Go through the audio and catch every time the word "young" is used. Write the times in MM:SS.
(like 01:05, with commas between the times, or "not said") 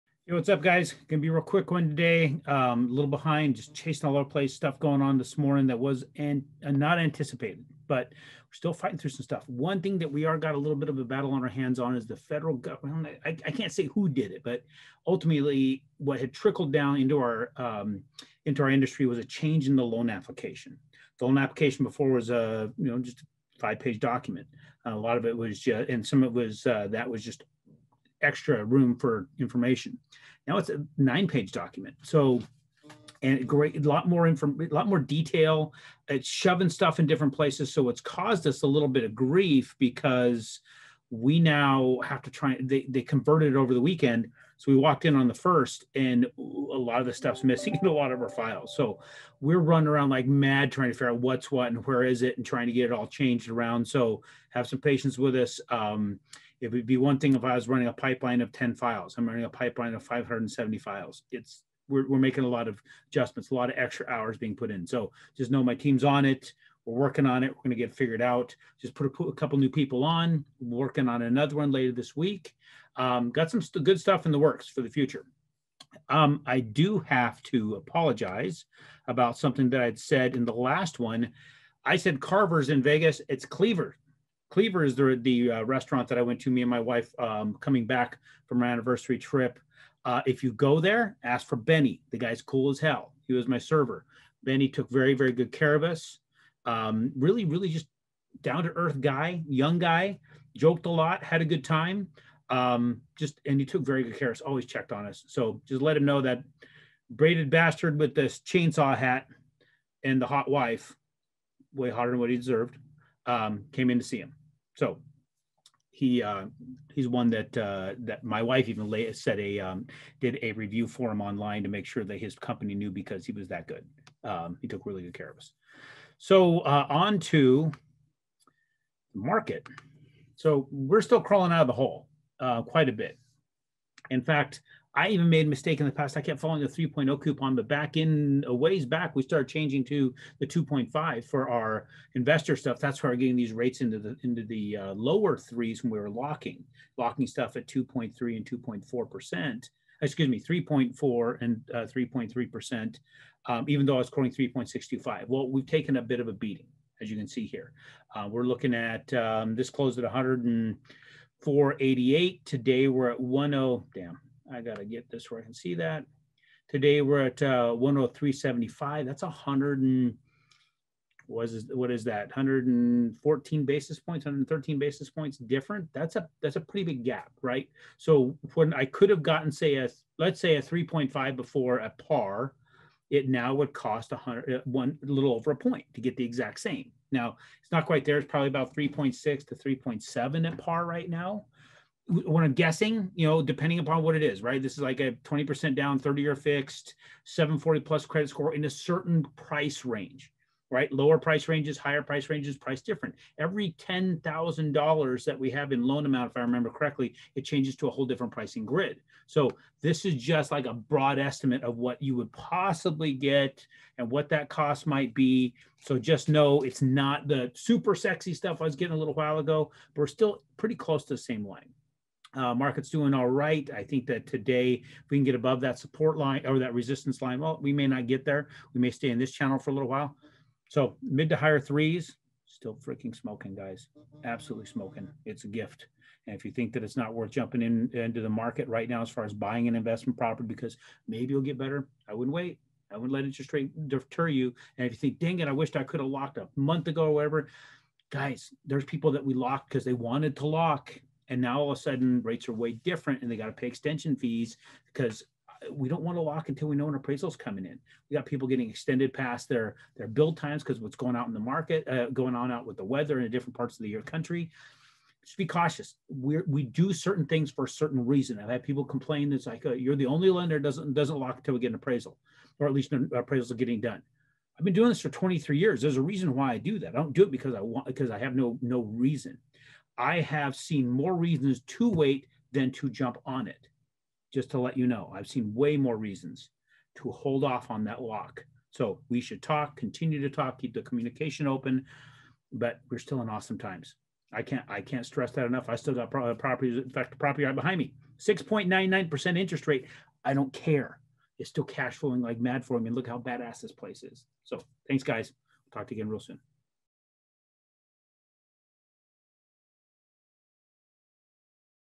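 01:39.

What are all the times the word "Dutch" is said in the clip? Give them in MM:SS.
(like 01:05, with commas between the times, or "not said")
not said.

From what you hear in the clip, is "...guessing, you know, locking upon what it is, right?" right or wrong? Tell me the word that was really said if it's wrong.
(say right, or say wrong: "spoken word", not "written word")
wrong: "depending", not "locking".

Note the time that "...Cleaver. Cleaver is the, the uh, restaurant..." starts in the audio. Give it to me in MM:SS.
01:23.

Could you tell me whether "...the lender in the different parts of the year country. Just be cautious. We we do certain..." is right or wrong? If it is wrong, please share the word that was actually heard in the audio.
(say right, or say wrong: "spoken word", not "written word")
wrong: "weather", not "lender".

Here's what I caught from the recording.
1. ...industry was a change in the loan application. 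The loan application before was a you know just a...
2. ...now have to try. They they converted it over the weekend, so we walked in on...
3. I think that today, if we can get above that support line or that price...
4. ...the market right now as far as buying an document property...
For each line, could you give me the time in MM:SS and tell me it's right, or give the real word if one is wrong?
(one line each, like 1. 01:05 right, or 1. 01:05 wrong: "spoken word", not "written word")
1. 00:18 right
2. 00:41 right
3. 03:43 wrong: "resistance", not "price"
4. 03:58 wrong: "investment", not "document".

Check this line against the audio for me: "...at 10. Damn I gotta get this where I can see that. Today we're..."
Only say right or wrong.
right.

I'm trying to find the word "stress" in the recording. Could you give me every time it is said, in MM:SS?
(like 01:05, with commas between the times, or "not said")
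04:55.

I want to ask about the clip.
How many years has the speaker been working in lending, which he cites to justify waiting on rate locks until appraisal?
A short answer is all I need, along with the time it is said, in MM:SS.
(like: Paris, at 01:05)
23, at 04:35.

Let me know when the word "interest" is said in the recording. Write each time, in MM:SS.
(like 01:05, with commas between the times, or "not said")
04:03, 04:59.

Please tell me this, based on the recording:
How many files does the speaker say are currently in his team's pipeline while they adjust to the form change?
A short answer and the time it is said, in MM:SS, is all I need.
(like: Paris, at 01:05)
570, at 01:00.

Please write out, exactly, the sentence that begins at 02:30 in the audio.
Excuse me, 3.4 and 3.3 uh, percent.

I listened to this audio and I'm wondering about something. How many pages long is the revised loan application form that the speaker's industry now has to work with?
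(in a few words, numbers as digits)
9.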